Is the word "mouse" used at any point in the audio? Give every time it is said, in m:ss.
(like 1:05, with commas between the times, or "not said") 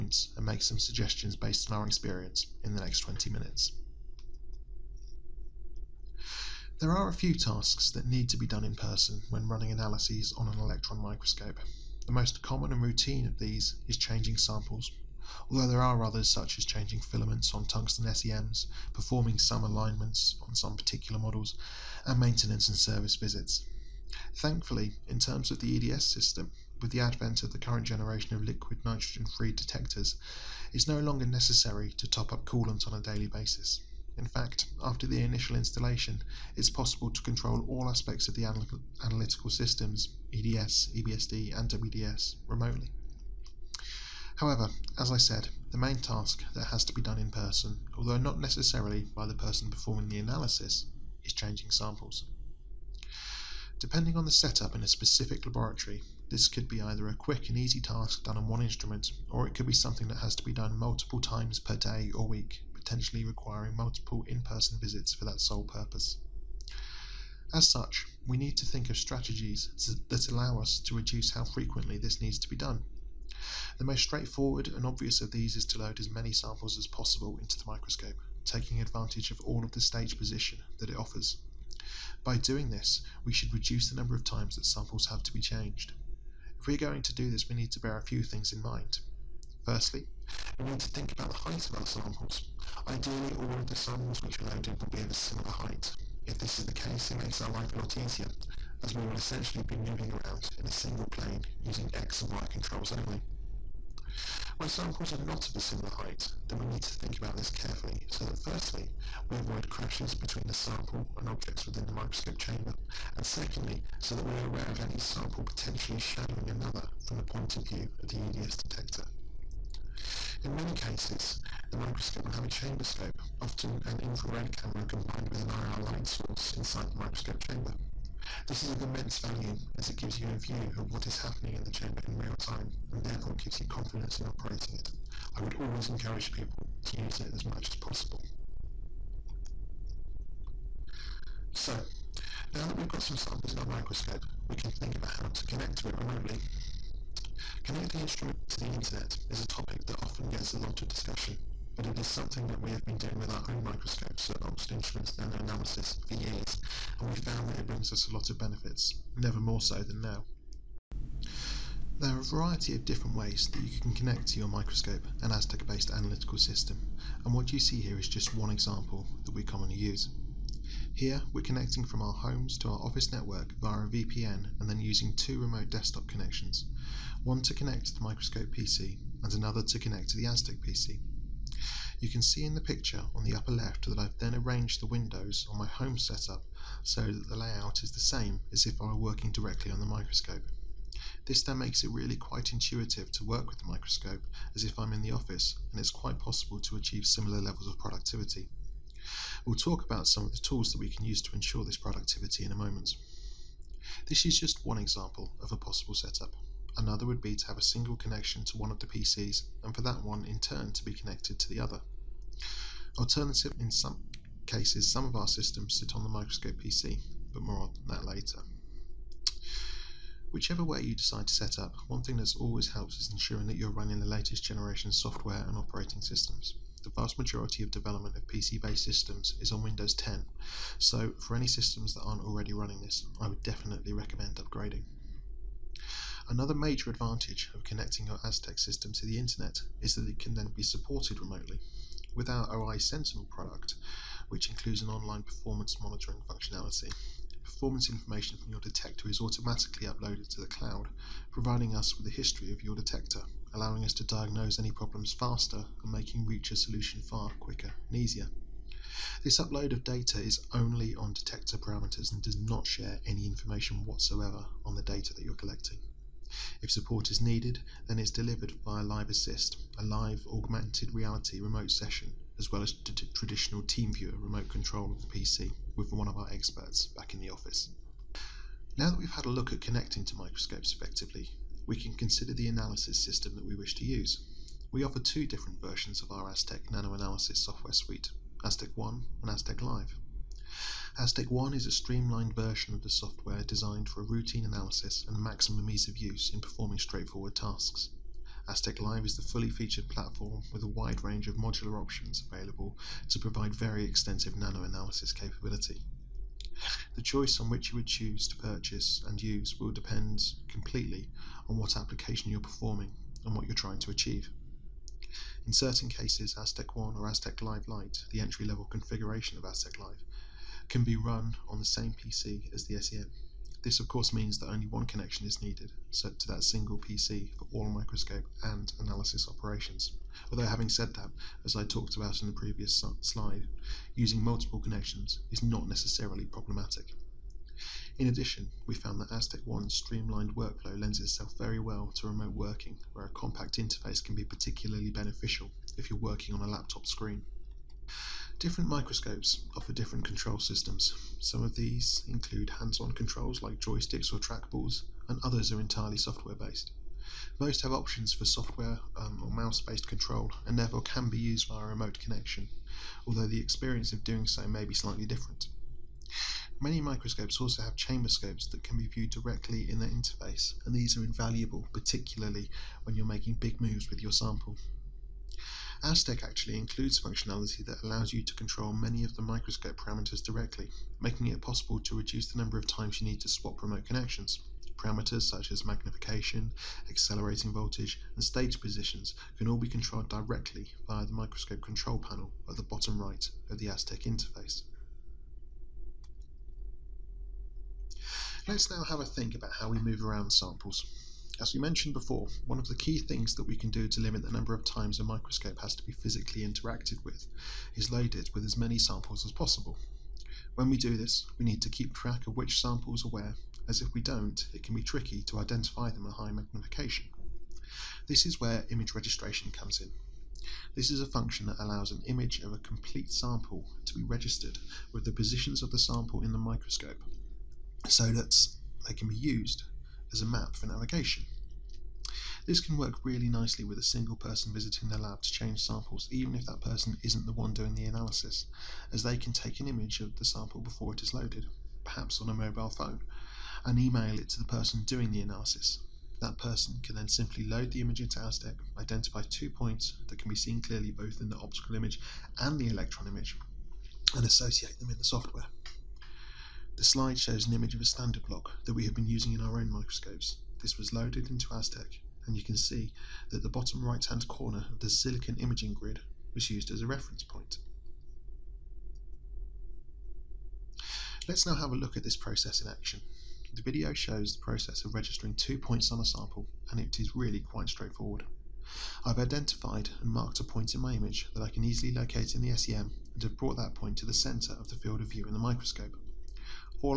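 5:59.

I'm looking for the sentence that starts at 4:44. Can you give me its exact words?
We offer two different versions of our Aztec nanoanalysis software suite, Aztec 1 and Aztec Live.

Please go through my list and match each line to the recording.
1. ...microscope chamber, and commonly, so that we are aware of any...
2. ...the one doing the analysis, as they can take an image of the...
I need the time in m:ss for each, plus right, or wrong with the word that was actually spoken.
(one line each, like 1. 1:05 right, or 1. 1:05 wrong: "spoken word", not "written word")
1. 1:51 wrong: "secondly", not "commonly"
2. 7:17 right.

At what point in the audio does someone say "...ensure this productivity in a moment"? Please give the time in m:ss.
3:21.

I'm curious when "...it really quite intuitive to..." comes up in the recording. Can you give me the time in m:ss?
3:11.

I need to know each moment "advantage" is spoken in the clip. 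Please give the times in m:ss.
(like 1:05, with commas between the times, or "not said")
1:18, 3:56.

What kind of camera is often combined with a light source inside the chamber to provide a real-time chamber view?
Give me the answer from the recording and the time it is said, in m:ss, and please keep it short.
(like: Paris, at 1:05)
Infrared camera, at 2:03.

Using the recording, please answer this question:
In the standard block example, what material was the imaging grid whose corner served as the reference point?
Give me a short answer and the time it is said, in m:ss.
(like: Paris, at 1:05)
Silicon, at 7:44.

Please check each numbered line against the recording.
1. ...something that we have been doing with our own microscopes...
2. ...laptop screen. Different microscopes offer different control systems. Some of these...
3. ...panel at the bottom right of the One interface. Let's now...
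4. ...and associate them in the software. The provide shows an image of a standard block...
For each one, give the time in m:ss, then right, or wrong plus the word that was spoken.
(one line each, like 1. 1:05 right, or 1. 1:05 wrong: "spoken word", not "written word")
1. 2:32 right
2. 5:46 right
3. 6:31 wrong: "Aztec", not "One"
4. 7:34 wrong: "slide", not "provide".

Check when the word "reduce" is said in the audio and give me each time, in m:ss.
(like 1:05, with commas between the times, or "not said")
1:10, 1:23, 6:21.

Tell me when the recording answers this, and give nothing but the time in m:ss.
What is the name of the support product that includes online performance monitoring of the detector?
4:02.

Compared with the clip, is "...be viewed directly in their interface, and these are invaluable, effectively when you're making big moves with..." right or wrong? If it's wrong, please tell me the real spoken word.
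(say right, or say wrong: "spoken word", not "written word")
wrong: "particularly", not "effectively".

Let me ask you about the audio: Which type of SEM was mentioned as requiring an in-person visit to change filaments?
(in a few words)
Tungsten SEMs.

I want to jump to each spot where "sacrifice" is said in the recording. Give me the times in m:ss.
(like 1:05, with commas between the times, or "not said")
not said.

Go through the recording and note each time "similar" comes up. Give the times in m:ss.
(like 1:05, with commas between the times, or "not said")
1:35, 1:45, 3:17.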